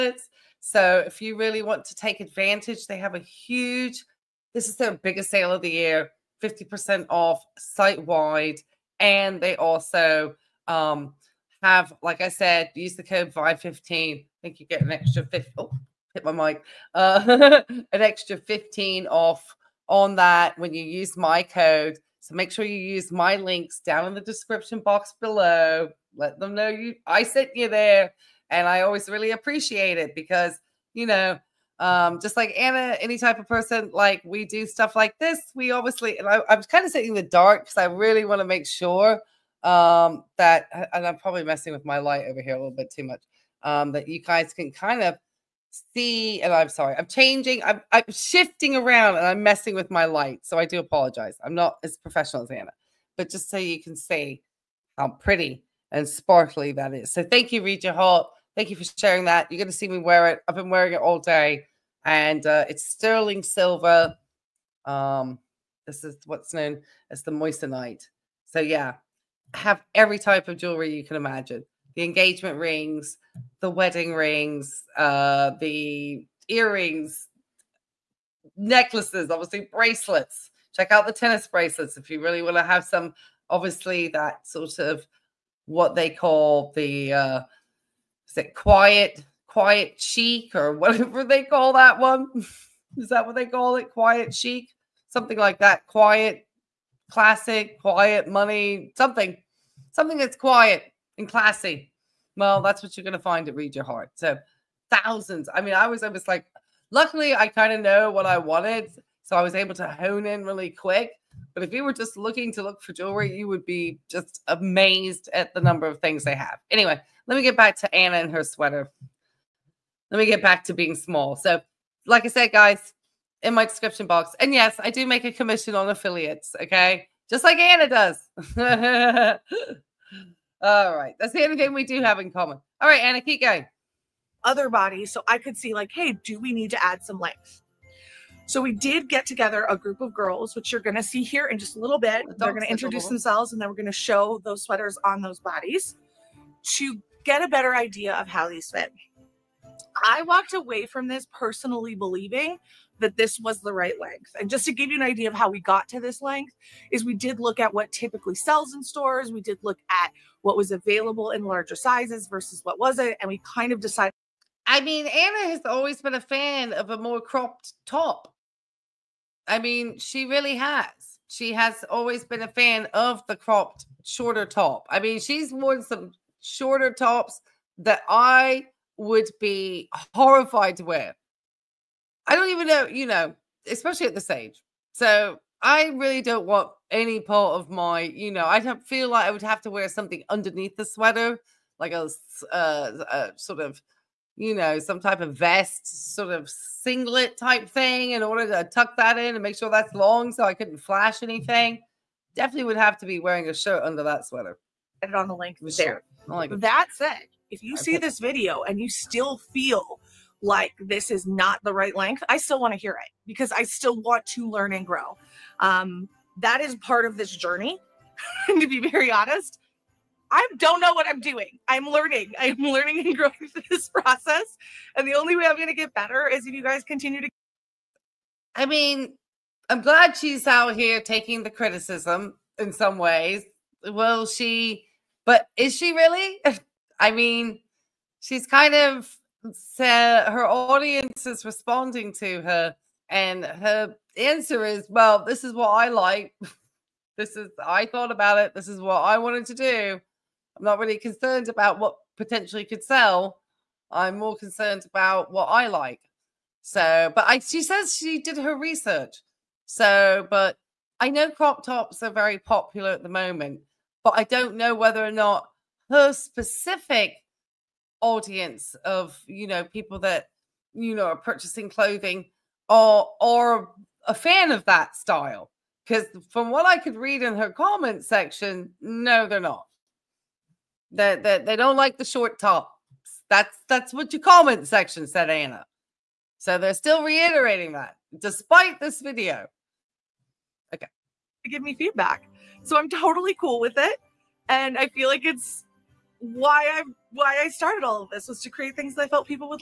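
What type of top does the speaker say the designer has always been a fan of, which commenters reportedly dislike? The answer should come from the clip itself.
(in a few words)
Cropped top.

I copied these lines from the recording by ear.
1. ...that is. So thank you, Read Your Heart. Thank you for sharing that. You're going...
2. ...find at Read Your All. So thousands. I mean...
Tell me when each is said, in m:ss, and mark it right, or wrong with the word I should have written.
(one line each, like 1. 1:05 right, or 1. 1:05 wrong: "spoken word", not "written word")
1. 0:56 right
2. 1:43 wrong: "Heart", not "All".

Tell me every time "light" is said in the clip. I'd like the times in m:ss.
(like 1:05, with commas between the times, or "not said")
0:41, 0:50.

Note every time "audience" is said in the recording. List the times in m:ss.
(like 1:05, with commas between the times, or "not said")
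4:00, 4:28.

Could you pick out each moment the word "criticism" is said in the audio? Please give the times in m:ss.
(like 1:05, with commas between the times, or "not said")
3:51.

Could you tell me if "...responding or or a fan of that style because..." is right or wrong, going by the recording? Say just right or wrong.
wrong.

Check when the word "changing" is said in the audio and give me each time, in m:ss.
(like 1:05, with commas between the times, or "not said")
0:47.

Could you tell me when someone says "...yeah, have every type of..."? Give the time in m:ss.
1:08.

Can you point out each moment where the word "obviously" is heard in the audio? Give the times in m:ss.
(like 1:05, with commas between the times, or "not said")
0:35, 1:19, 1:23.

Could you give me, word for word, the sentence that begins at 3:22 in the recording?
Definitely would have to be wearing a shirt under that sweater.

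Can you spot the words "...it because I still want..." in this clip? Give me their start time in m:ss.
3:32.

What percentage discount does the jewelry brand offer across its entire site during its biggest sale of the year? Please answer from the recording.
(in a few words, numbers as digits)
50%.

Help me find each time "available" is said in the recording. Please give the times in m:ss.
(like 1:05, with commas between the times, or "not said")
2:40.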